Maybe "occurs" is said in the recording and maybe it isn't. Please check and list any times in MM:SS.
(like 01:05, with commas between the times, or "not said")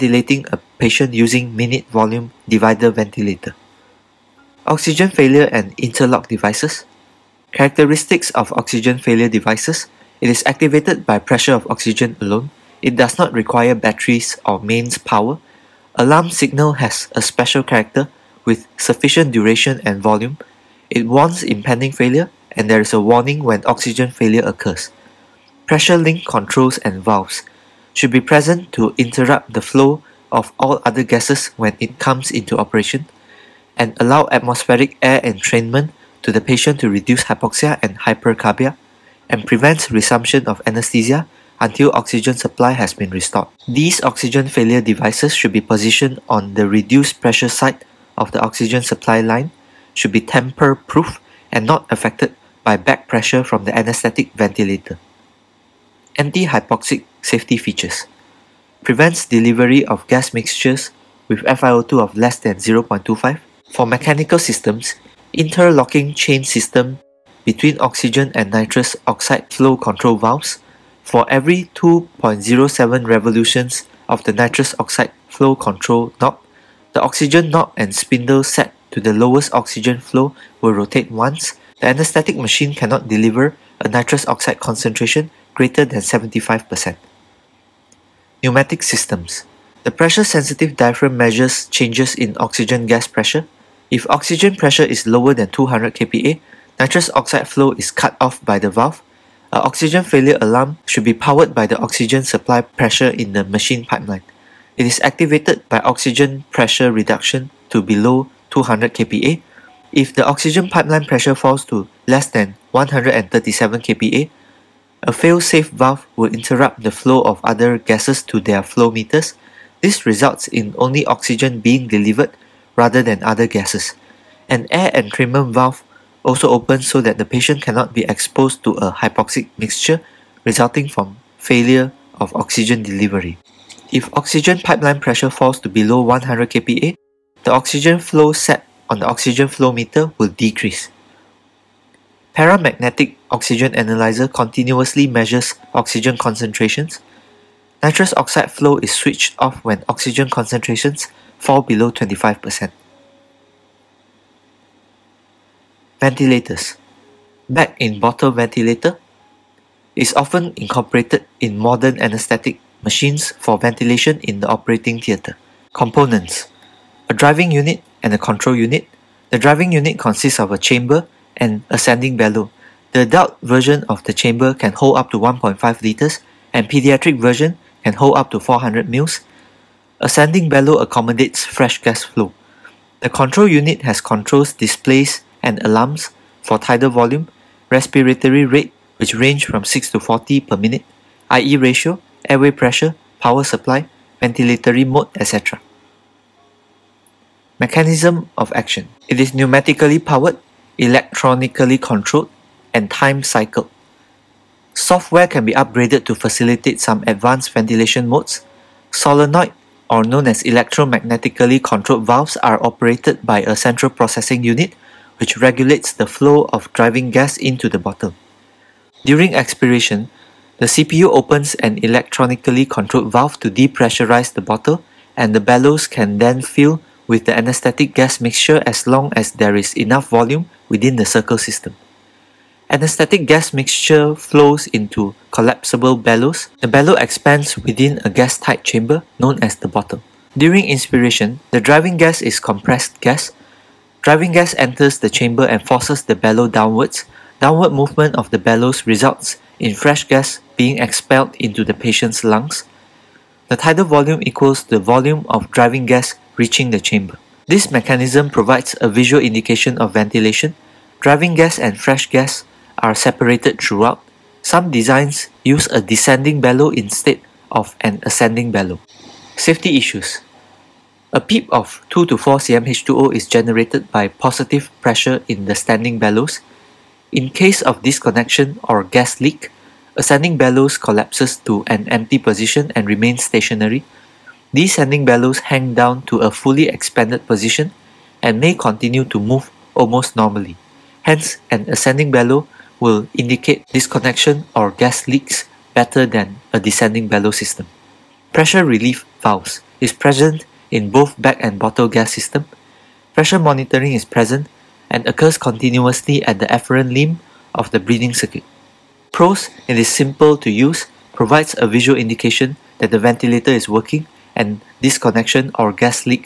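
00:24, 05:05.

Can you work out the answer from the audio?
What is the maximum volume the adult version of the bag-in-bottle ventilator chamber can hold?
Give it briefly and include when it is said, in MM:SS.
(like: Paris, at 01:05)
1.5 liters, at 02:55.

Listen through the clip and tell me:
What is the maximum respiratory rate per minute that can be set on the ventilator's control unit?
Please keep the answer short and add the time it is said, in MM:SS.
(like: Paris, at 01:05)
40, at 03:10.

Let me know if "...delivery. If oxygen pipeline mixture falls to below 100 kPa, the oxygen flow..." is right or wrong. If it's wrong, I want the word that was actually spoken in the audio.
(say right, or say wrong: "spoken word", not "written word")
wrong: "pressure", not "mixture".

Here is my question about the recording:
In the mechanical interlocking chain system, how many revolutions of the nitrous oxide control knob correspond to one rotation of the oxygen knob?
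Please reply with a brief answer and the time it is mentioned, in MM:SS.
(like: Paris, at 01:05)
2.07, at 01:11.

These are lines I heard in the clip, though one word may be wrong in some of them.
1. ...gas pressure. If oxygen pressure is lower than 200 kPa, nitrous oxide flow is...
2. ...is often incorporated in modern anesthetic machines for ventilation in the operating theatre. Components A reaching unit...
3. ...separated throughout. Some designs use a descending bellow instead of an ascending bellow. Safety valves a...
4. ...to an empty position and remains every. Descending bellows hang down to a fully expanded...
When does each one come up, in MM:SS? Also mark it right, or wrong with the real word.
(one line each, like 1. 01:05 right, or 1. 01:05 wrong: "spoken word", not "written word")
1. 01:32 right
2. 02:39 wrong: "driving", not "reaching"
3. 04:22 wrong: "issues", not "valves"
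4. 04:41 wrong: "stationary", not "every".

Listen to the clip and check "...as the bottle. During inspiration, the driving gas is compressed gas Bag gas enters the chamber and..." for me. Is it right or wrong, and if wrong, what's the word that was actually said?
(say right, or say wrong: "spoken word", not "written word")
wrong: "Driving", not "Bag".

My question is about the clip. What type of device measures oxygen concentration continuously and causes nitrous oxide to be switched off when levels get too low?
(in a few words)
Paramagnetic oxygen analyzer.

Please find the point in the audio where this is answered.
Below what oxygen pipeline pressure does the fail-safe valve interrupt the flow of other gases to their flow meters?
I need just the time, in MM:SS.
01:52.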